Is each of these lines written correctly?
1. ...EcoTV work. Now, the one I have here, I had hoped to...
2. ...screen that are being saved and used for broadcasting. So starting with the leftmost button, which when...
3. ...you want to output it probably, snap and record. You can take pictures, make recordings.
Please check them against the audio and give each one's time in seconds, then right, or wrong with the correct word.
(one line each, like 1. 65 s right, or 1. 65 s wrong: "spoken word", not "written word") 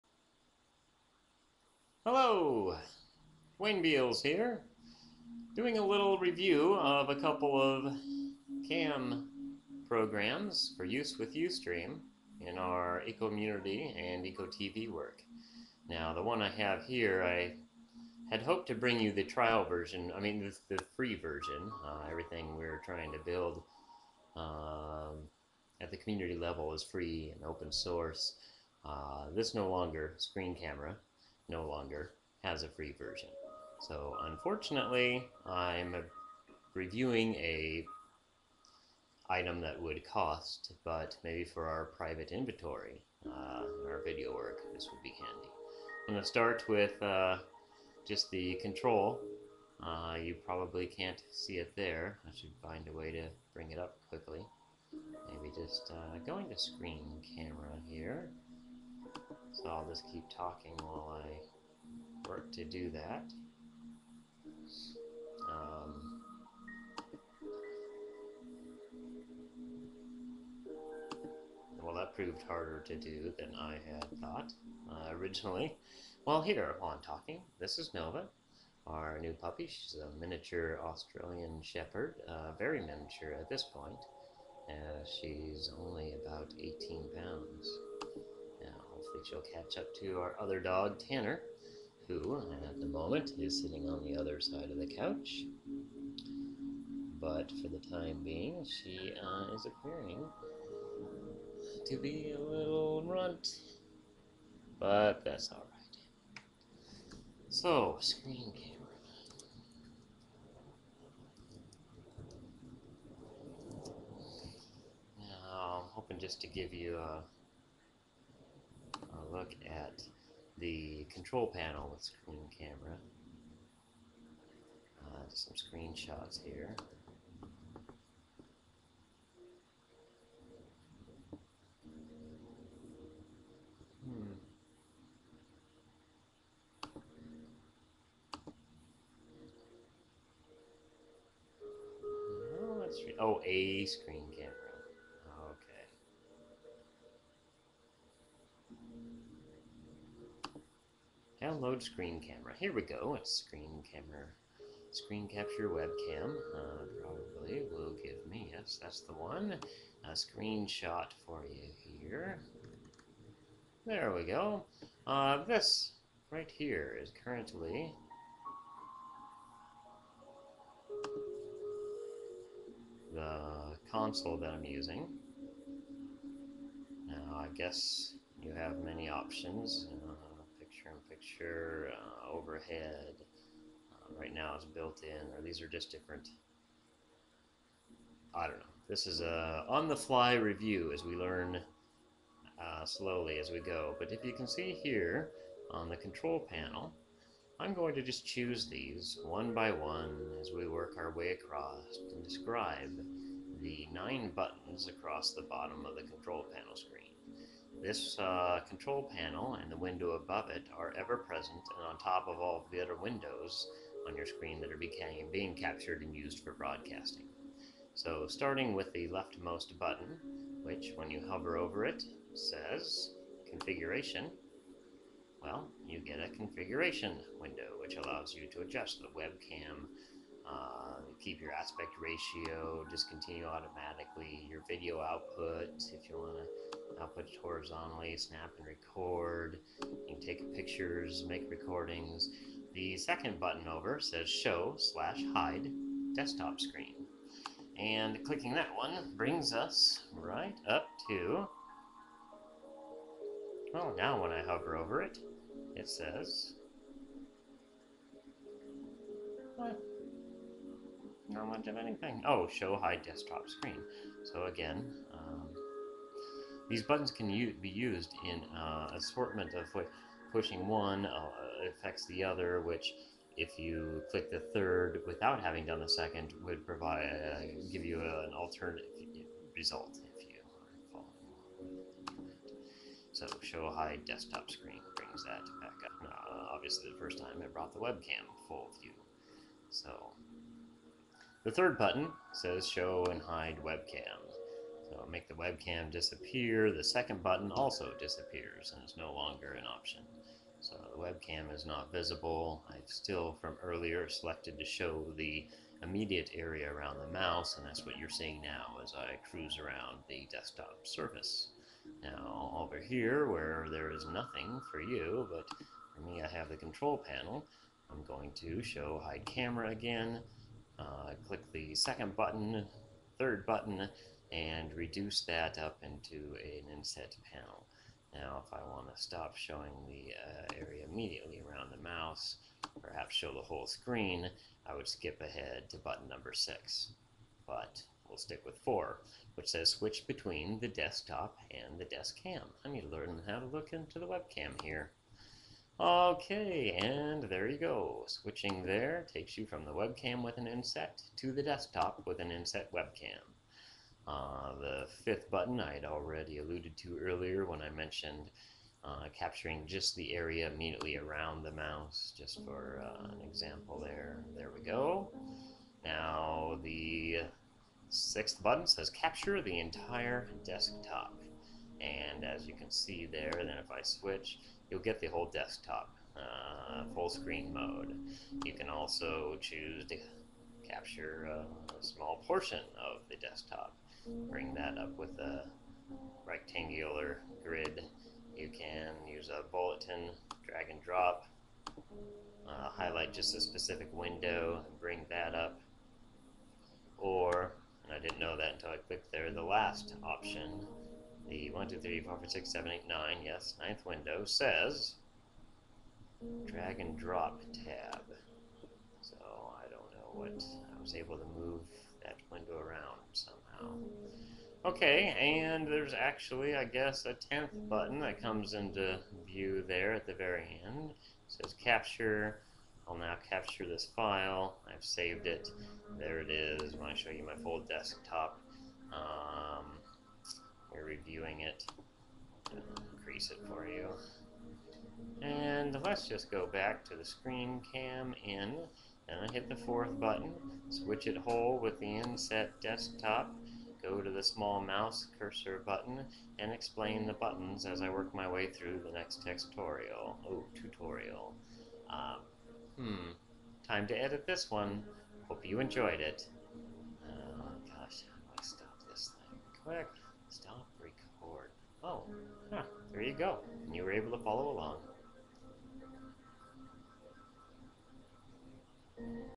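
1. 14 s right
2. 214 s wrong: "captured", not "saved"
3. 236 s wrong: "horizontally", not "probably".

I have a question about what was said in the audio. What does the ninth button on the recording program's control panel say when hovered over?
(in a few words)
drag and drop tab.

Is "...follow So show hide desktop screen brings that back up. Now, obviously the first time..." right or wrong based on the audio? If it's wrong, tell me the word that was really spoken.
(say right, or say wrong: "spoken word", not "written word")
right.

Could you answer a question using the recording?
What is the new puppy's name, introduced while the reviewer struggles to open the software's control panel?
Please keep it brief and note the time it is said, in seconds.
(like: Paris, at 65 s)
Nova, at 77 s.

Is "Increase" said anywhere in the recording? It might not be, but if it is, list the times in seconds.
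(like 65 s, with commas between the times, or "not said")
432 s.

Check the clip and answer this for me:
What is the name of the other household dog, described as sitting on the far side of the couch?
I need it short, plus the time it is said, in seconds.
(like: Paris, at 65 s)
Tanner, at 90 s.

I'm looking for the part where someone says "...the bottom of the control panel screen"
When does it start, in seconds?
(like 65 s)
205 s.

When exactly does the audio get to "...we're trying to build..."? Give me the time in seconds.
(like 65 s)
22 s.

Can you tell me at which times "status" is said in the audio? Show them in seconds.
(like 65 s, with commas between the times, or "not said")
not said.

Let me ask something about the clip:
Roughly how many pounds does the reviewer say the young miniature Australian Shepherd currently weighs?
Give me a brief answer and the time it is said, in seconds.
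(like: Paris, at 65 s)
18, at 86 s.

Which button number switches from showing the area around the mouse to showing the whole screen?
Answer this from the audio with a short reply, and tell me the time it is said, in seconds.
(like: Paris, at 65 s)
6, at 335 s.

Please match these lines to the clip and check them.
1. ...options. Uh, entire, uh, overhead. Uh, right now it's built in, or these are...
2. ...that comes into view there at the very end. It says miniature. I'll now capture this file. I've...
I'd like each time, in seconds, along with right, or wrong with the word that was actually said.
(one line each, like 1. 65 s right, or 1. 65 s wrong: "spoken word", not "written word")
1. 179 s wrong: "temperature", not "entire"
2. 418 s wrong: "capture", not "miniature".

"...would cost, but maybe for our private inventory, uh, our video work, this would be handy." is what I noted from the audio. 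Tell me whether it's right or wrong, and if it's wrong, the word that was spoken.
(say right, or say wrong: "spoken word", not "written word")
right.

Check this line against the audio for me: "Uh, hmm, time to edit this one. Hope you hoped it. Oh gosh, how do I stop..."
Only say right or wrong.
wrong.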